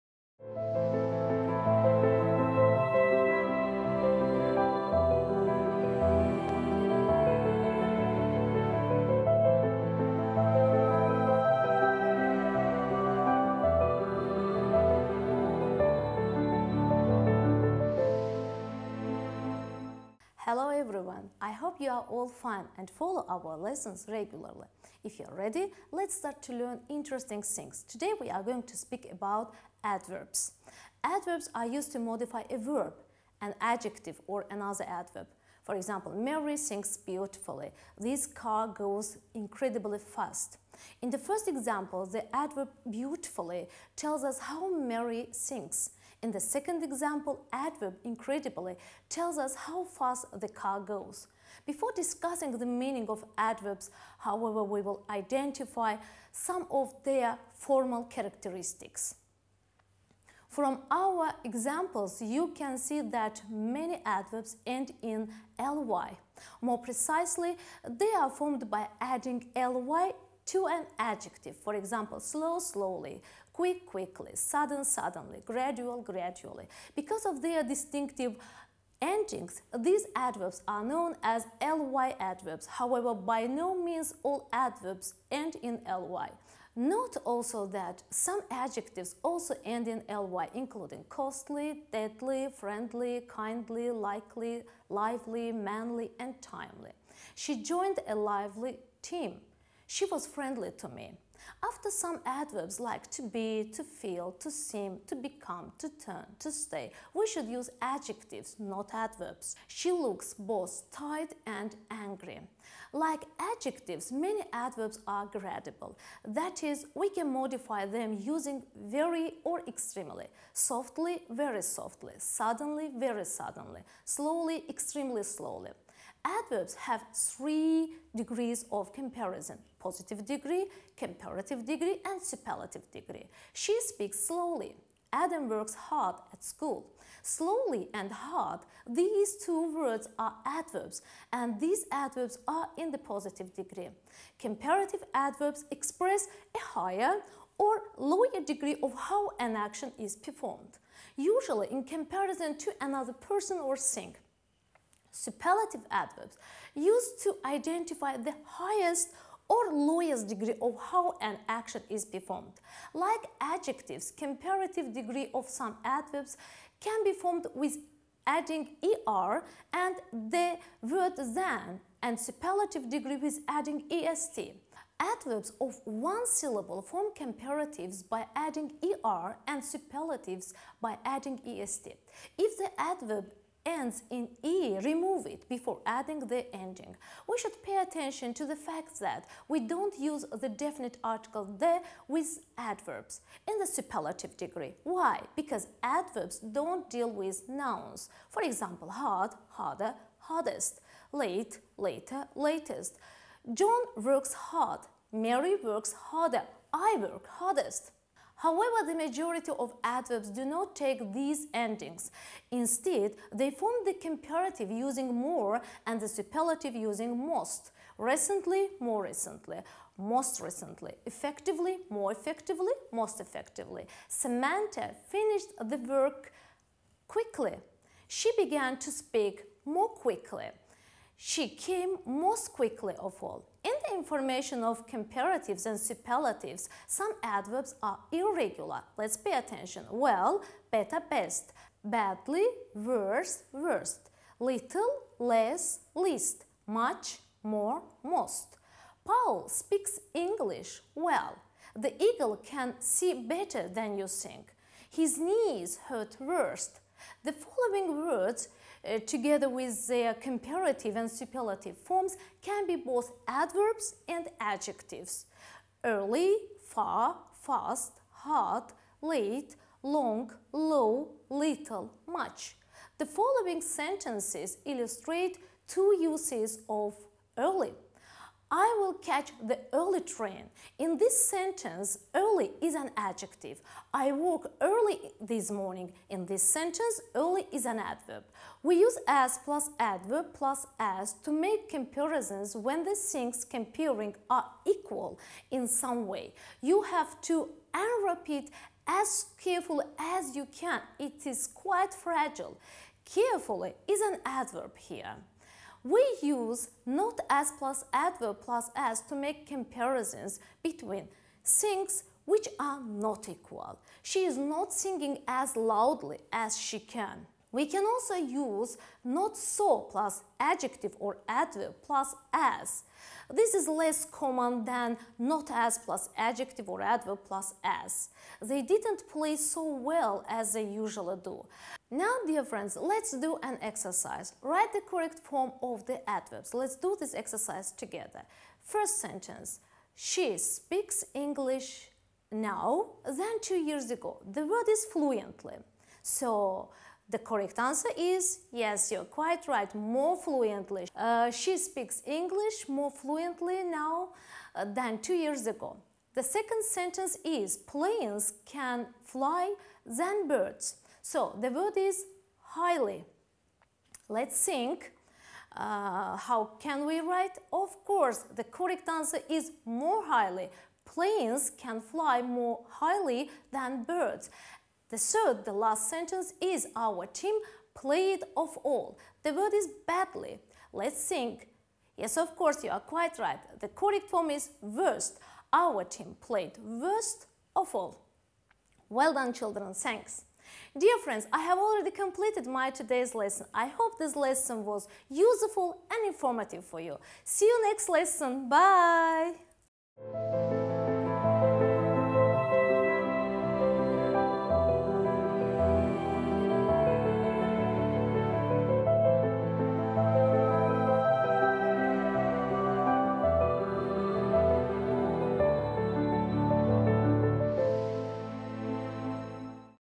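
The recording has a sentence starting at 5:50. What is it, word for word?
Uh, she speaks English more fluently now uh, than two years ago.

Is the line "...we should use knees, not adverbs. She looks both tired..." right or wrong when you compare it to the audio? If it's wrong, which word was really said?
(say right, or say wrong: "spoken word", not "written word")
wrong: "adjectives", not "knees".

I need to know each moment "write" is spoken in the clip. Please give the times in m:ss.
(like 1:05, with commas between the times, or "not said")
5:34, 6:07.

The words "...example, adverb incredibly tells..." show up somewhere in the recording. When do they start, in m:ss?
0:46.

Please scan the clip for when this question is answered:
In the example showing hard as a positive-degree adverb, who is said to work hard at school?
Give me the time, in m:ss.
2:15.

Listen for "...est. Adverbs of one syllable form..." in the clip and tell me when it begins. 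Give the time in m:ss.
2:53.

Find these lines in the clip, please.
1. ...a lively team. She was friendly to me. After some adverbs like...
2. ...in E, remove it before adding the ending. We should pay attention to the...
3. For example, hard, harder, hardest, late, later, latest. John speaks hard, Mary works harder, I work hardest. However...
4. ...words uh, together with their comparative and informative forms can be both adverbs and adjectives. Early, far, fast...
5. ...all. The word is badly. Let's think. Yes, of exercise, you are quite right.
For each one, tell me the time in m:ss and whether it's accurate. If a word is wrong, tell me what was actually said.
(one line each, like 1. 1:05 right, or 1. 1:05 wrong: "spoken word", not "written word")
1. 1:38 right
2. 3:04 right
3. 3:18 wrong: "works", not "speaks"
4. 4:18 wrong: "superlative", not "informative"
5. 6:18 wrong: "course", not "exercise".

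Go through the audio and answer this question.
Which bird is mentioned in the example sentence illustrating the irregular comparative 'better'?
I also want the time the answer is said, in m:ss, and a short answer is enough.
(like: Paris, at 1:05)
eagle, at 4:11.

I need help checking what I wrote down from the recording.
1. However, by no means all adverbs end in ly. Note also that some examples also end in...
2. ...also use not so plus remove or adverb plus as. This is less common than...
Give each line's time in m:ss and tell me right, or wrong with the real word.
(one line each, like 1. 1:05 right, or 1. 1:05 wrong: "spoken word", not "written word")
1. 1:22 wrong: "adjectives", not "examples"
2. 5:17 wrong: "adjective", not "remove".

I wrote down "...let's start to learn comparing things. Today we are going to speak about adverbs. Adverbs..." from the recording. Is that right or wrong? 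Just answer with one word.
wrong.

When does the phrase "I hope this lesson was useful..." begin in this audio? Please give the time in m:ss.
6:33.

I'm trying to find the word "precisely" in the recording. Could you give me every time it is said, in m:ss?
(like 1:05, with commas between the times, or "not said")
1:06.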